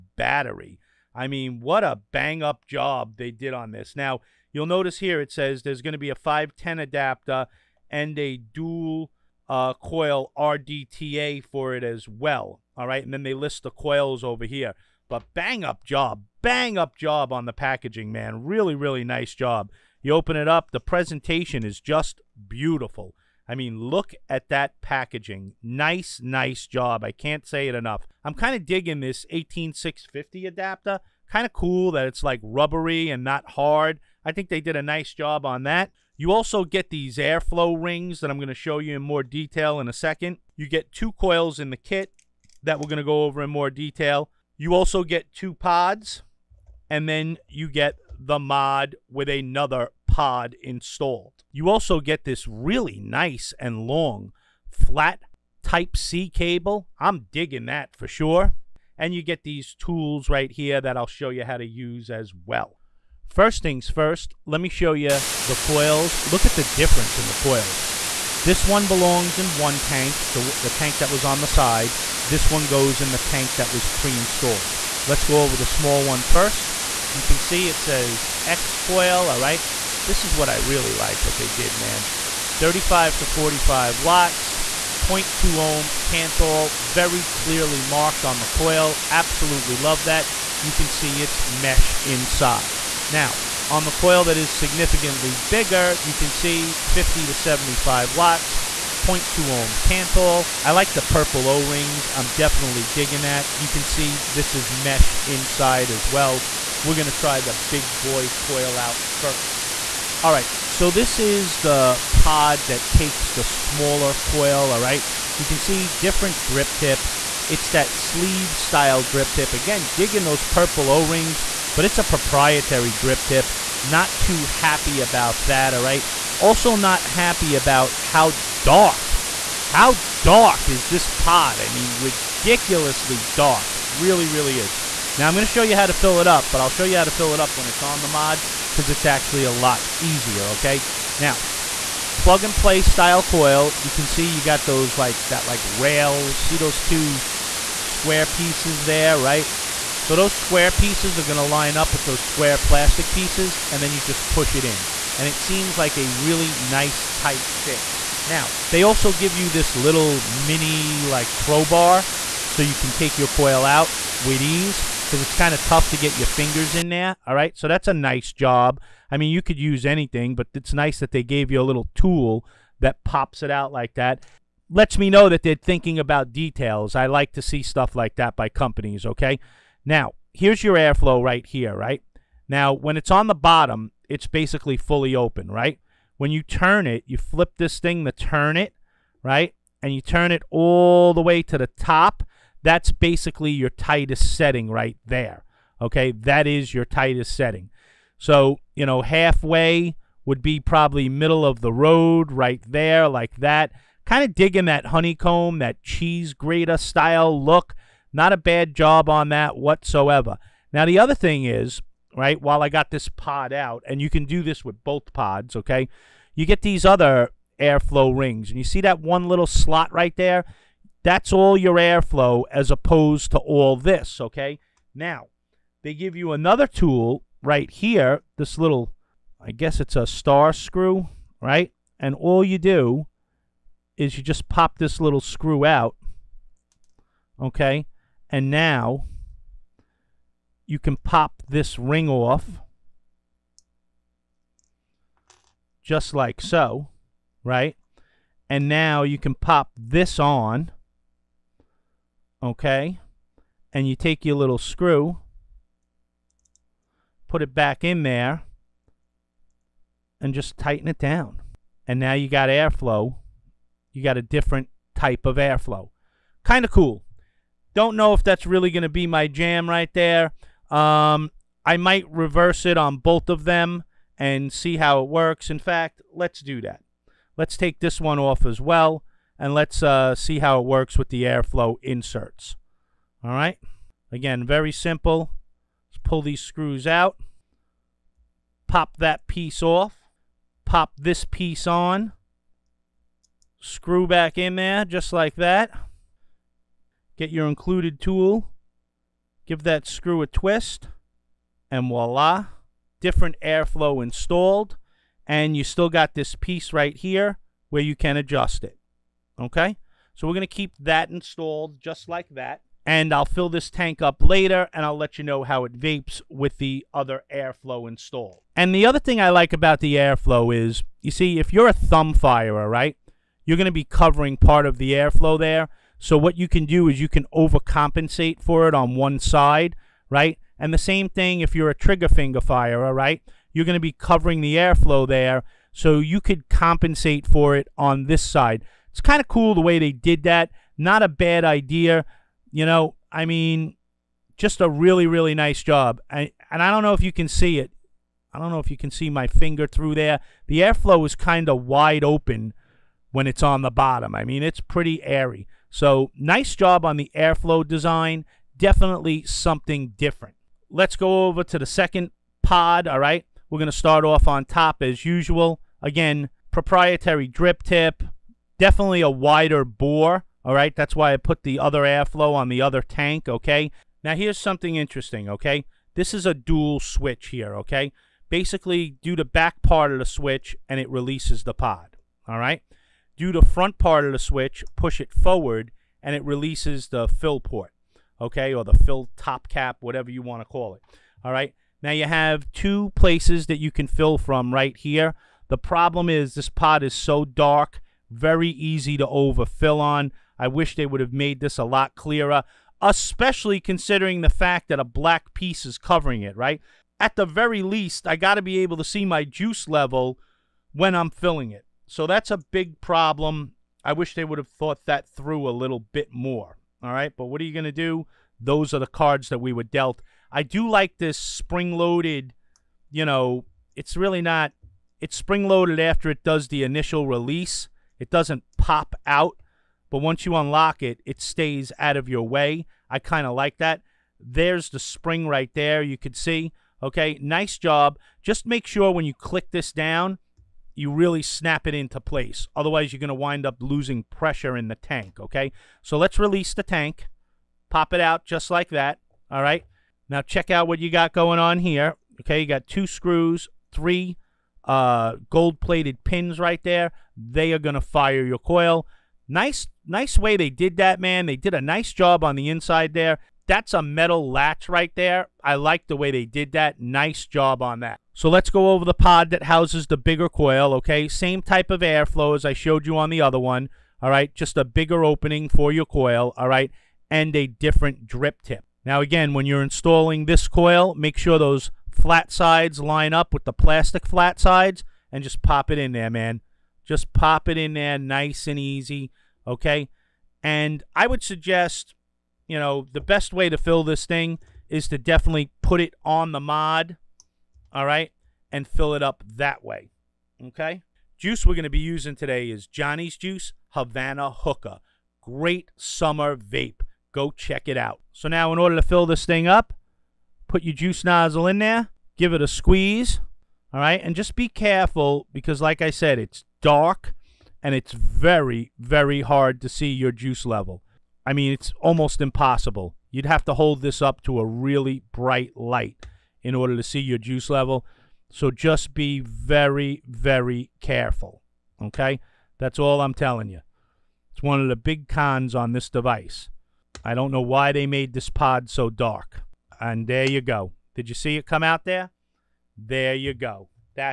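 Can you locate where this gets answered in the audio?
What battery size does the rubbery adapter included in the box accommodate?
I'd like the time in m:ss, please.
0:29.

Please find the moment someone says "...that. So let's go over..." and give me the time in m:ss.
7:47.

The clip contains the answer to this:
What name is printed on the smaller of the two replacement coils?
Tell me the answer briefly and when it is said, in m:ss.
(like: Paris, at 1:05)
X coil, at 1:18.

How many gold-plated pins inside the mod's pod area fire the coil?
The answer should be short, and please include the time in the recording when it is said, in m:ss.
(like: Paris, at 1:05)
3, at 7:33.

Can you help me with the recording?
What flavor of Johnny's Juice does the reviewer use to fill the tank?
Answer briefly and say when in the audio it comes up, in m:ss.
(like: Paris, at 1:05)
Havana Hookah, at 8:23.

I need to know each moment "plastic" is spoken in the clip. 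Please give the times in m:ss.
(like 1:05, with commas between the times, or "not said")
2:32, 8:03.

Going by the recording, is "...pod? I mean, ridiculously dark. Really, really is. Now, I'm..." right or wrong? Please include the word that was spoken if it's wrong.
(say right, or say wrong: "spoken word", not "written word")
right.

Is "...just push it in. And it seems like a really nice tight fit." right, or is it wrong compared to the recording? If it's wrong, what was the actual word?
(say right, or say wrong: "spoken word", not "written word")
right.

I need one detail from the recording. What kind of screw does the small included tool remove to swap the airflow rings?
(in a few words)
Star screw.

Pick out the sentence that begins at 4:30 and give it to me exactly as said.
Um, I might reverse it on both of them and see how it works.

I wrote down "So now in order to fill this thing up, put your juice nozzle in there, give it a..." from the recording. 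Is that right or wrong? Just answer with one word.
right.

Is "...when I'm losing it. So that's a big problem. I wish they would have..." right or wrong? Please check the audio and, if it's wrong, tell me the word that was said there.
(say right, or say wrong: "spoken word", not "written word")
wrong: "filling", not "losing".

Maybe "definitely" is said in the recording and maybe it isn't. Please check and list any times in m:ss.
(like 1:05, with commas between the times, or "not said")
1:42, 5:58, 6:08, 8:14.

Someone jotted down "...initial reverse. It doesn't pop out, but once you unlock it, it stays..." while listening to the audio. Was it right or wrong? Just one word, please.
wrong.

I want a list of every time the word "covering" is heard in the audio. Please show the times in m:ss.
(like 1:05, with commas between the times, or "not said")
5:23, 5:33, 6:45.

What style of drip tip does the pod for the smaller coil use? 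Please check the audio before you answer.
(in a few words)
Sleeve style.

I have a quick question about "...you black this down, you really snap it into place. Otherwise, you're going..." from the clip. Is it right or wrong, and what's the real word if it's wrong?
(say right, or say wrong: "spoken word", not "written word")
wrong: "click", not "black".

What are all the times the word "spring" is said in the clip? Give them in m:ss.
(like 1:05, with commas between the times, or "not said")
7:01, 7:05, 7:14.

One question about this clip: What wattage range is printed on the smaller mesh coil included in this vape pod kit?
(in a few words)
35 to 45 watts.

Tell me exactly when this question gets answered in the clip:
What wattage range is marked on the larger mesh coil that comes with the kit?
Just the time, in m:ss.
1:36.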